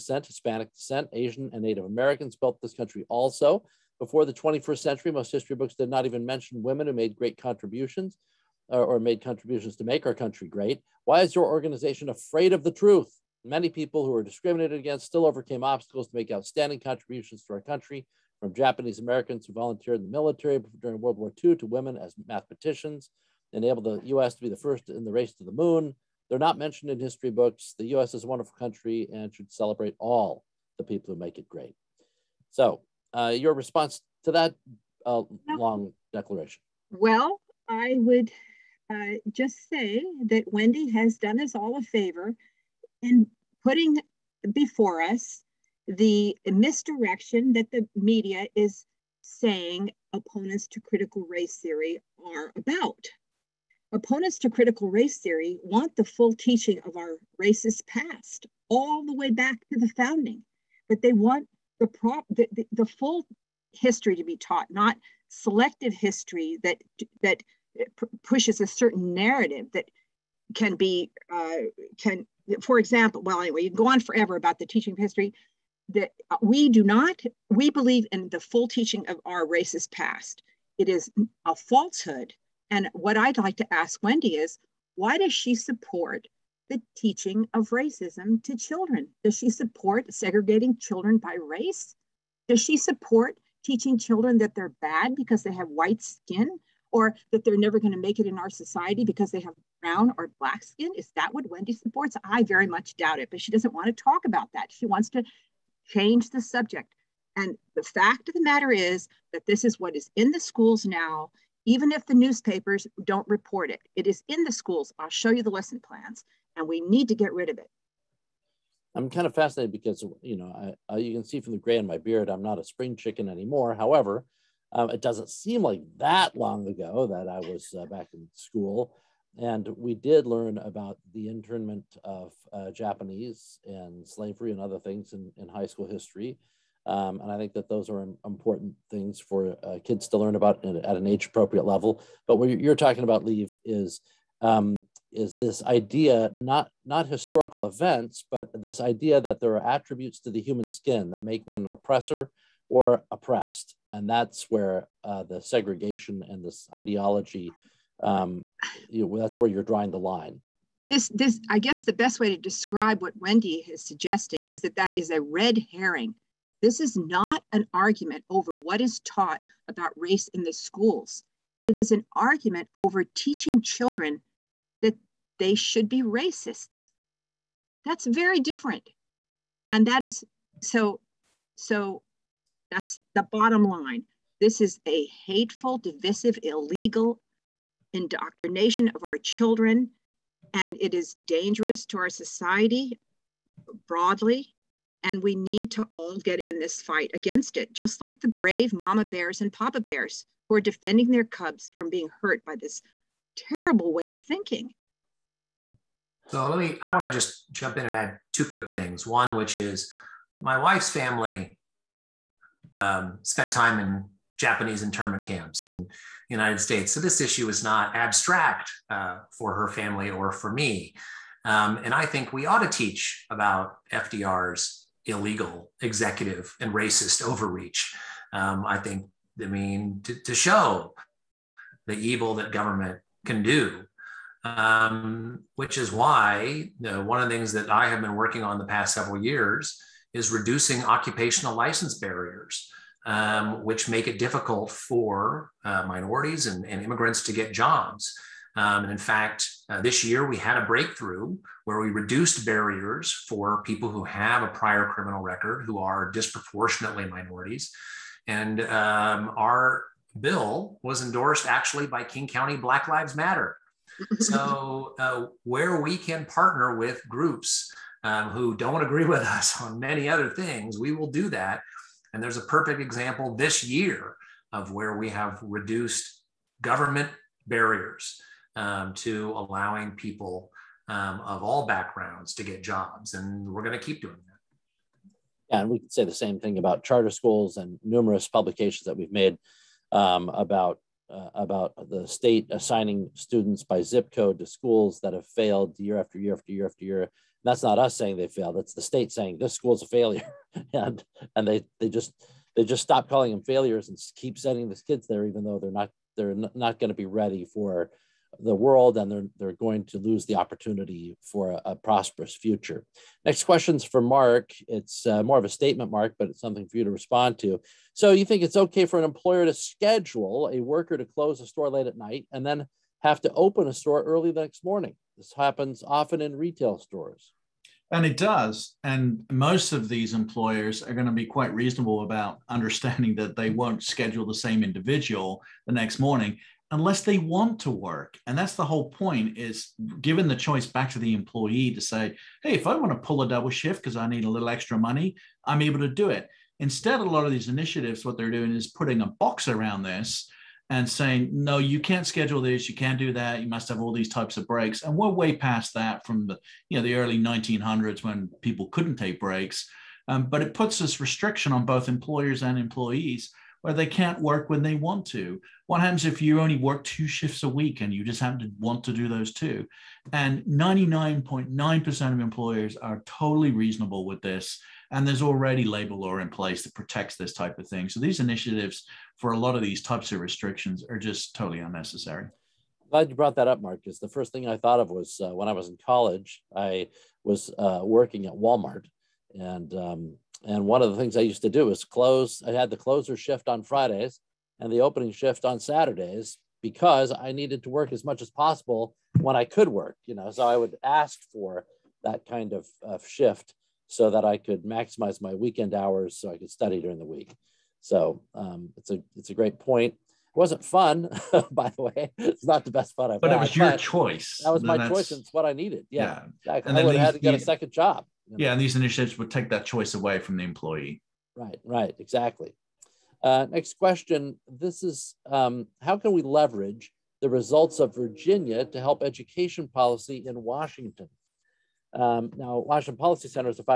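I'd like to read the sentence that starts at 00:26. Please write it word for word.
They're not mentioned in history books.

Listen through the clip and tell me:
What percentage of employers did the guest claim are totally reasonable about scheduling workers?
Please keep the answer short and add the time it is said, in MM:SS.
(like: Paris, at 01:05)
99.9%, at 06:10.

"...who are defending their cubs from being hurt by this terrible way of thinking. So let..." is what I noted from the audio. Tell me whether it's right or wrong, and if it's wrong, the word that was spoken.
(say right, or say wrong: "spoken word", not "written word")
right.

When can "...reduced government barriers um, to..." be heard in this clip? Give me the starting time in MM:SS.
04:35.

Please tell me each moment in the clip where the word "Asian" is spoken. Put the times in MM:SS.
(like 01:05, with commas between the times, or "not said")
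00:01.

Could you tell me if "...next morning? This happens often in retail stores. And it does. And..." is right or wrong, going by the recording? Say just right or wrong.
right.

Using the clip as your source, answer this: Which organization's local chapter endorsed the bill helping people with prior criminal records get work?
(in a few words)
King County Black Lives Matter.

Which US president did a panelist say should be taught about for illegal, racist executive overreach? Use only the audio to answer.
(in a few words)
FDR.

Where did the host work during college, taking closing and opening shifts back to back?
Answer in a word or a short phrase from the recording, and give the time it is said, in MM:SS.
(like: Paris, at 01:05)
Walmart, at 06:28.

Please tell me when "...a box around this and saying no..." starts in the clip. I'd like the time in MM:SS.
05:49.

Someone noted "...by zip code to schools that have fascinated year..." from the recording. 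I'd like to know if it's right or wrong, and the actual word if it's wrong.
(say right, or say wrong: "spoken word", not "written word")
wrong: "failed", not "fascinated".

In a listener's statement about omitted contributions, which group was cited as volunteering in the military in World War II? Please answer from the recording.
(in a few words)
Japanese Americans.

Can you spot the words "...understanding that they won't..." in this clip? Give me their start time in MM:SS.
05:32.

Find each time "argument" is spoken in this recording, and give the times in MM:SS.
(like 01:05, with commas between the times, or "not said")
02:47, 02:52.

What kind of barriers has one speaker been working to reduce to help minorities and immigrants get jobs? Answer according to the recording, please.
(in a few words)
occupational license barriers.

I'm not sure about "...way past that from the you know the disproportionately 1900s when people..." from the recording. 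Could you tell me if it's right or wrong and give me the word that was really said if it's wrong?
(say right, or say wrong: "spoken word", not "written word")
wrong: "early", not "disproportionately".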